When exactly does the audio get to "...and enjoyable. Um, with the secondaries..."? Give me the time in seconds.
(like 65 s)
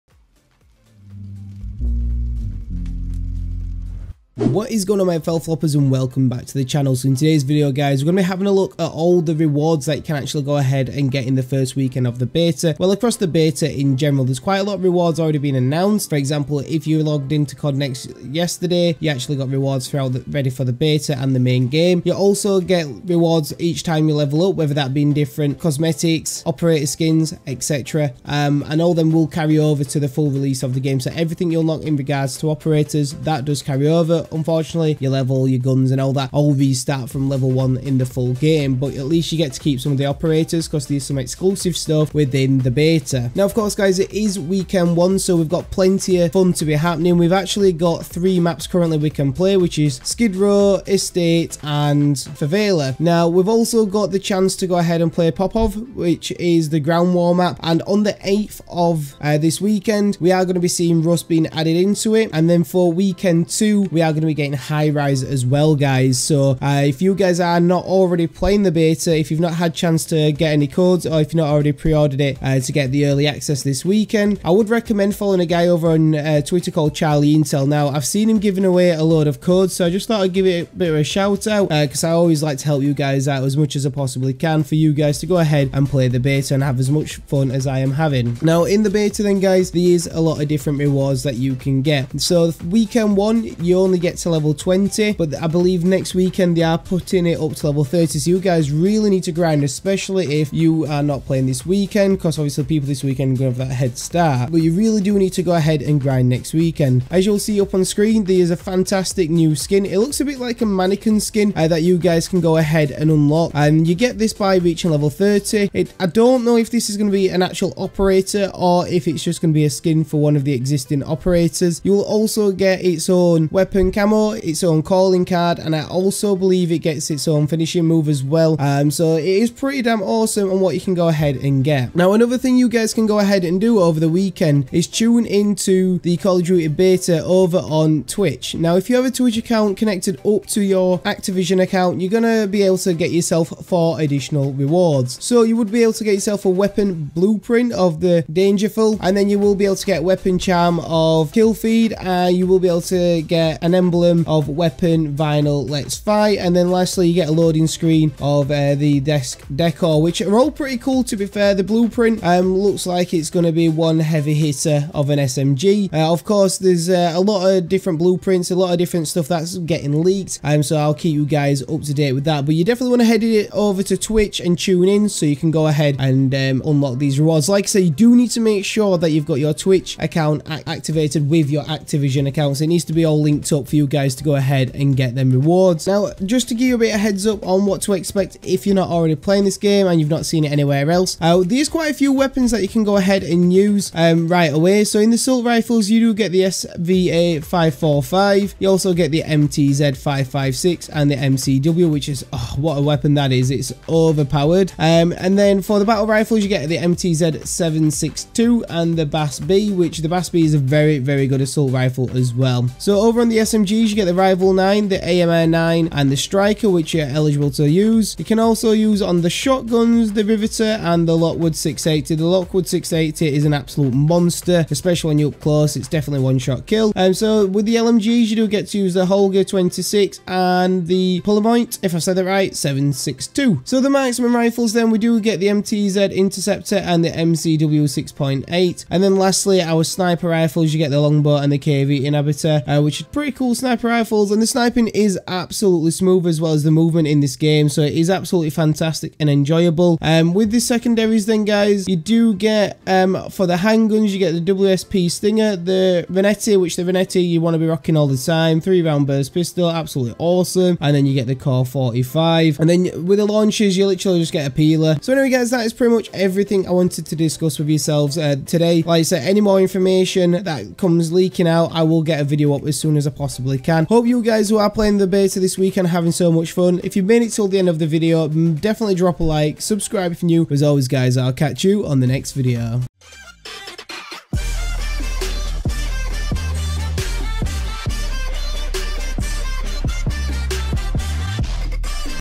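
249 s.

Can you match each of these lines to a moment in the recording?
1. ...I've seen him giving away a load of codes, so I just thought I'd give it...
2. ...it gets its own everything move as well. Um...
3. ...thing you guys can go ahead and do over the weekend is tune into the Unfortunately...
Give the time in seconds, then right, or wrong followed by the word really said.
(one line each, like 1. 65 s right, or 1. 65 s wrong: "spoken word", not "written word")
1. 77 s right
2. 126 s wrong: "finishing", not "everything"
3. 132 s wrong: "Call", not "Unfortunately".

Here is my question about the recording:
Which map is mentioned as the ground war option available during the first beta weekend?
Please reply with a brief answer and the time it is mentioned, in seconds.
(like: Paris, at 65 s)
Popov, at 55 s.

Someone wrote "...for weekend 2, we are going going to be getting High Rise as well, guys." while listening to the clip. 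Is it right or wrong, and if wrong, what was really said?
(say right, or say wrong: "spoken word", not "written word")
right.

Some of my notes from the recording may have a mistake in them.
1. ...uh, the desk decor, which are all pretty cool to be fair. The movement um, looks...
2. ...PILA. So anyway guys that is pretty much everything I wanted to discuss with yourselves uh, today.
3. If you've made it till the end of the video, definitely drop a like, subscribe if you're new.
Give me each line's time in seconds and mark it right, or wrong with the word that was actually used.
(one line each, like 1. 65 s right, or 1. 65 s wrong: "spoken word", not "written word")
1. 158 s wrong: "blueprint", not "movement"
2. 264 s right
3. 276 s right.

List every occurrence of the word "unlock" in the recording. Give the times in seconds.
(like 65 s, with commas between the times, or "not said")
31 s, 113 s, 176 s.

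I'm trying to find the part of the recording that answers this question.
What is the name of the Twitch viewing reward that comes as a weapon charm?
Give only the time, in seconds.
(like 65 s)
151 s.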